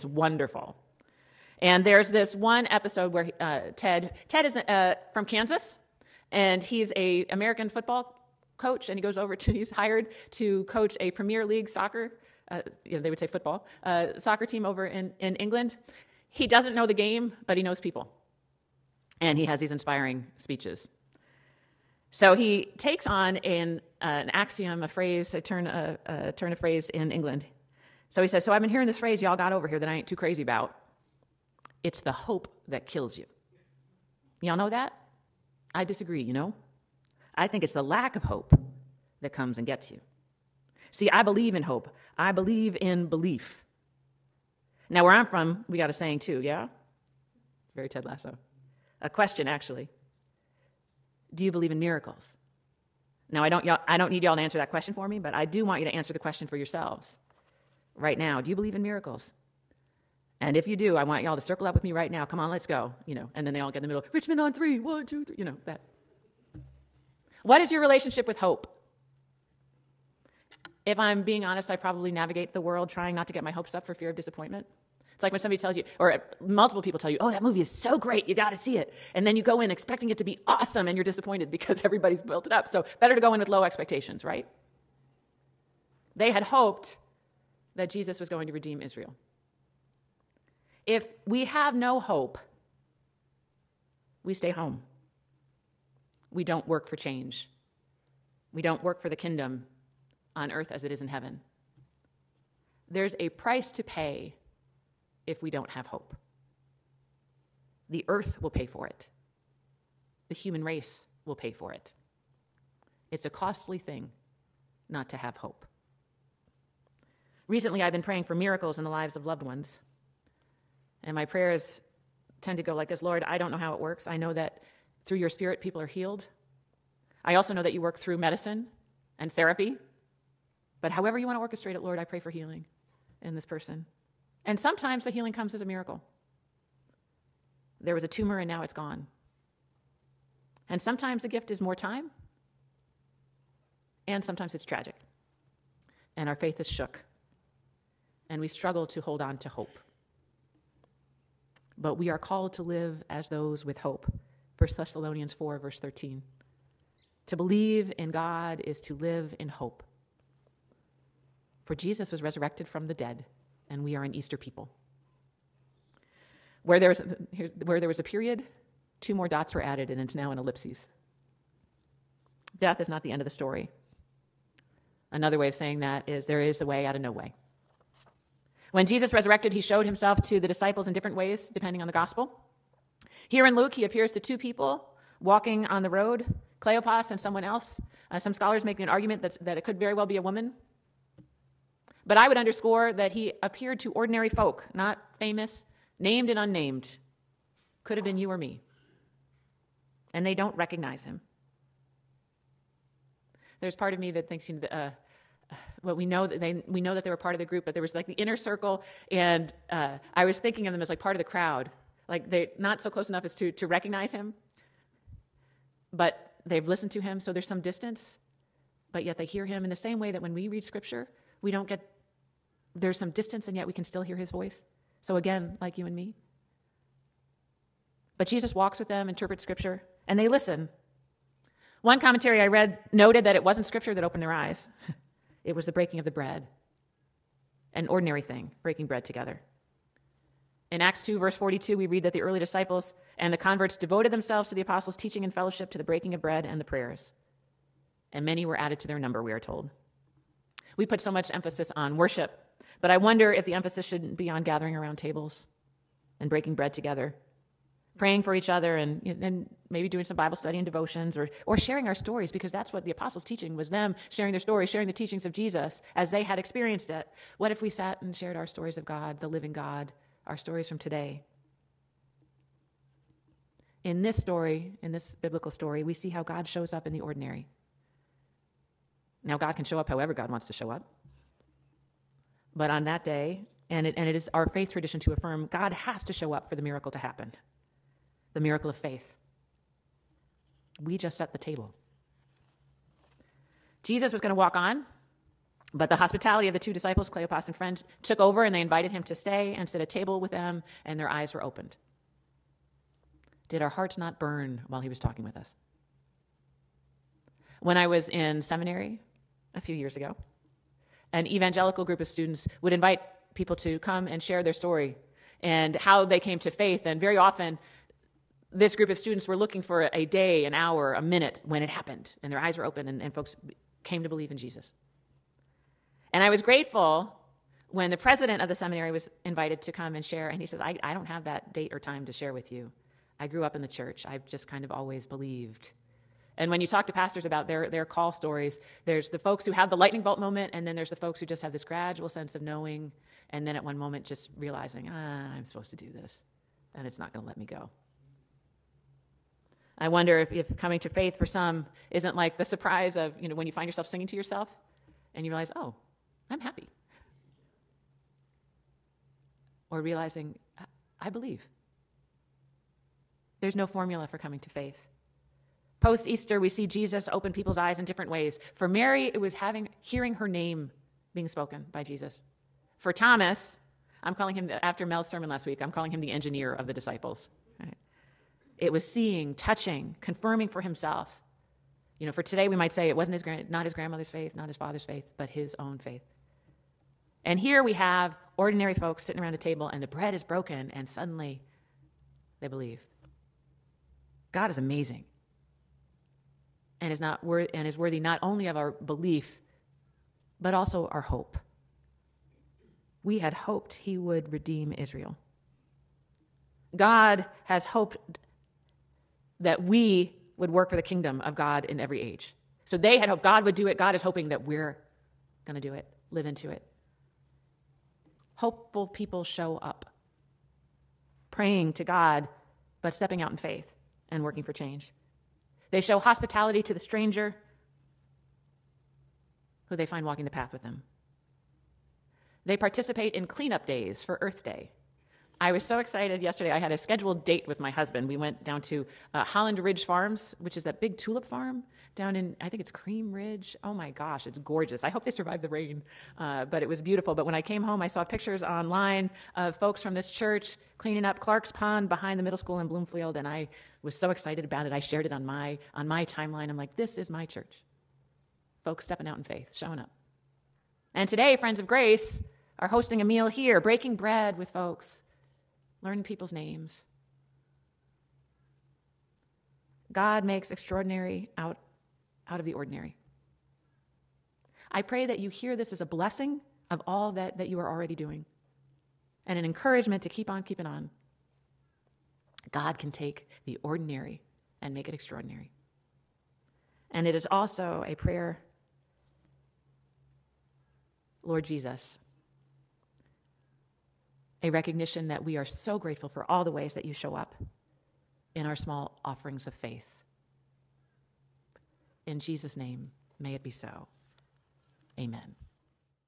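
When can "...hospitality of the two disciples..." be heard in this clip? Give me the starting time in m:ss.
4:55.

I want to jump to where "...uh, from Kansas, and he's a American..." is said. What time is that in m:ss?
0:04.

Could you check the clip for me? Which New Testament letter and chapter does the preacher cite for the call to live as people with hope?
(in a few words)
1 Thessalonians 4.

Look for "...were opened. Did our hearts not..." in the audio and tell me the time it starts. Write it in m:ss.
5:01.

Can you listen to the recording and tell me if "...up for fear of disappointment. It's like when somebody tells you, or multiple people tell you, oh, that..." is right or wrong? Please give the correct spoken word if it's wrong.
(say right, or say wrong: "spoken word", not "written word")
right.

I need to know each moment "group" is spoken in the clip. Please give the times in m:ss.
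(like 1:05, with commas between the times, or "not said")
3:27, 5:11, 5:18.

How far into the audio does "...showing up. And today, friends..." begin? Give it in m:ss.
7:39.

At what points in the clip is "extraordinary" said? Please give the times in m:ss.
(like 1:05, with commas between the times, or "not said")
7:50, 8:04.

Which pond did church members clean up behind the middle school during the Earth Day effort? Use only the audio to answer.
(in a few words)
Clark's Pond.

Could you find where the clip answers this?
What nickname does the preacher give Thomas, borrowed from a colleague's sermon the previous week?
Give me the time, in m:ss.
6:16.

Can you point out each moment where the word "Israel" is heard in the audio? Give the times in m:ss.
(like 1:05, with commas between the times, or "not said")
1:28, 6:44.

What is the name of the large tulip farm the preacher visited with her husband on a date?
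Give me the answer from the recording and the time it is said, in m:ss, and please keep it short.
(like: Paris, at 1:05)
Holland Ridge Farms, at 7:19.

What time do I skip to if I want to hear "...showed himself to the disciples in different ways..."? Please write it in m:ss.
2:59.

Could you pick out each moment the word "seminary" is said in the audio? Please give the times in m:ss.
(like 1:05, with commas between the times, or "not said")
5:08, 5:28.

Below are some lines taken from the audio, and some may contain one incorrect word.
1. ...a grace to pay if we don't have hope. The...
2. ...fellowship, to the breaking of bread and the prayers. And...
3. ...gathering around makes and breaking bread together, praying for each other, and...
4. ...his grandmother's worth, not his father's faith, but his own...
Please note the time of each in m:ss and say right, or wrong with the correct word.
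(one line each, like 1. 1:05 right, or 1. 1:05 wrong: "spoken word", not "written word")
1. 1:43 wrong: "price", not "grace"
2. 4:05 right
3. 4:14 wrong: "tables", not "makes"
4. 6:23 wrong: "faith", not "worth".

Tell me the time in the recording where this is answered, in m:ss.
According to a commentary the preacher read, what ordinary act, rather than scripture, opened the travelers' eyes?
3:55.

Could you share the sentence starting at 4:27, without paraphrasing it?
What if we sat and shared our stories of God, the living God, our stories from today?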